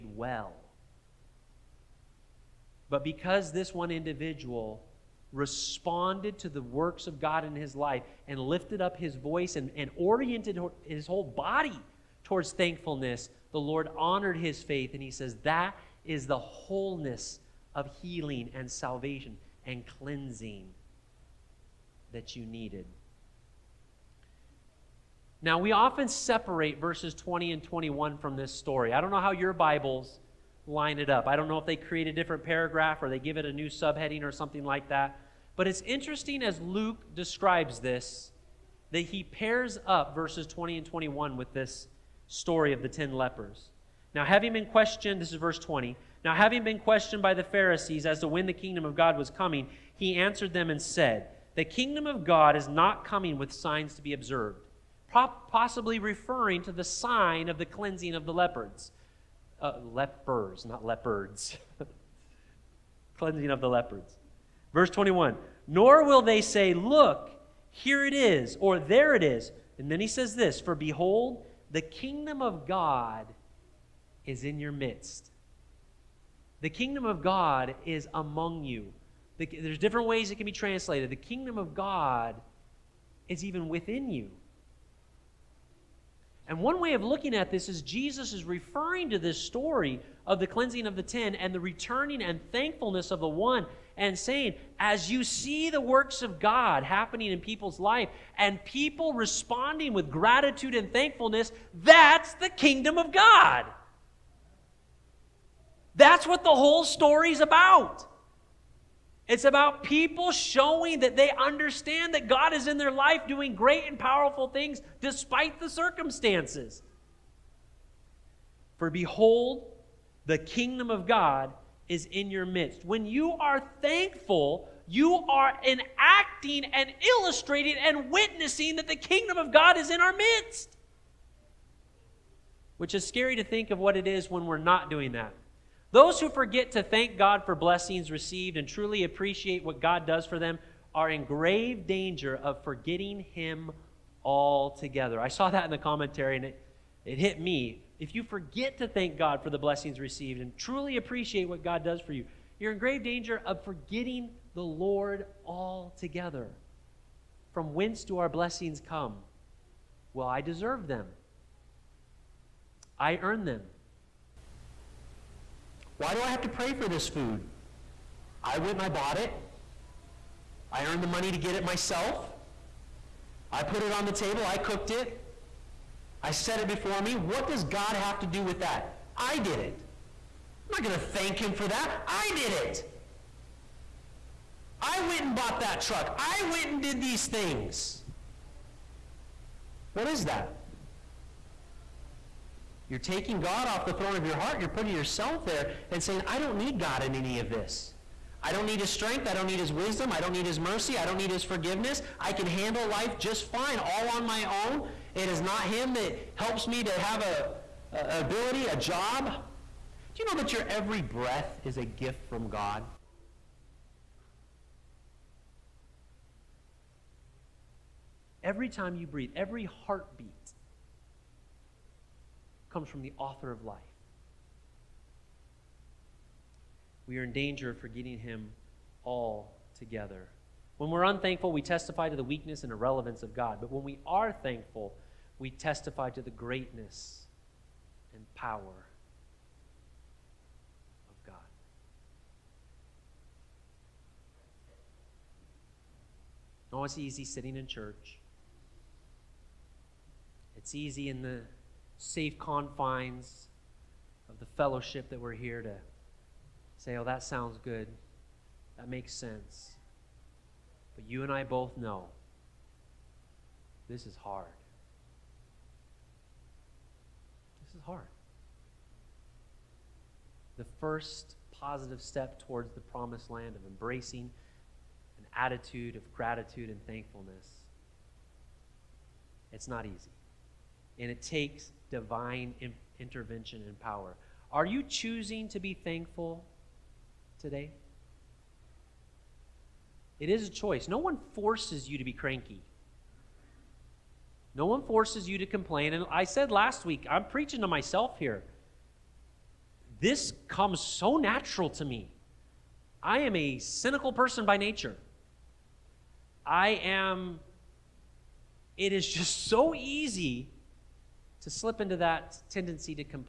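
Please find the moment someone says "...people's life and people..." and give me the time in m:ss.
1:37.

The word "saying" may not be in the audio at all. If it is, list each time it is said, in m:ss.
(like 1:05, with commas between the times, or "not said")
1:34, 3:16.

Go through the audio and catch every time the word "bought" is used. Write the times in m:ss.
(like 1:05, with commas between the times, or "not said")
2:48, 3:05.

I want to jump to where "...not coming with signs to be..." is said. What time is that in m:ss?
0:52.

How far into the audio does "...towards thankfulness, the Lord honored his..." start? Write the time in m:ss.
0:12.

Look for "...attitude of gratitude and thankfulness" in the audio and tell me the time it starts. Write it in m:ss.
4:35.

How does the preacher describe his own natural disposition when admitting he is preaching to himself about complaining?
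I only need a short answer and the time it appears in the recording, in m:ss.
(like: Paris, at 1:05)
cynical, at 5:03.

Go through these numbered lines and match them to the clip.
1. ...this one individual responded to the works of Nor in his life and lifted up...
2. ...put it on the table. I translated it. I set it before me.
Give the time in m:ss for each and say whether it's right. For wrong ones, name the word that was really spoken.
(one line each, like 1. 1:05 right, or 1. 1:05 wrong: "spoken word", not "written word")
1. 0:03 wrong: "God", not "Nor"
2. 2:53 wrong: "cooked", not "translated".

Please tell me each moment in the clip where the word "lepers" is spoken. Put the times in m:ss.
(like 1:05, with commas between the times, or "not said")
0:43, 0:59.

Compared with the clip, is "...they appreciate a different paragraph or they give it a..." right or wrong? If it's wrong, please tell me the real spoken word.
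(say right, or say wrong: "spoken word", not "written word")
wrong: "create", not "appreciate".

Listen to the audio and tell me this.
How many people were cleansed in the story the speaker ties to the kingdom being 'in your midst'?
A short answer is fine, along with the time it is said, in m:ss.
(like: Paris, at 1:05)
10, at 1:31.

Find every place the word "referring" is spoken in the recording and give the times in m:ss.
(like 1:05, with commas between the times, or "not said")
0:55, 1:28.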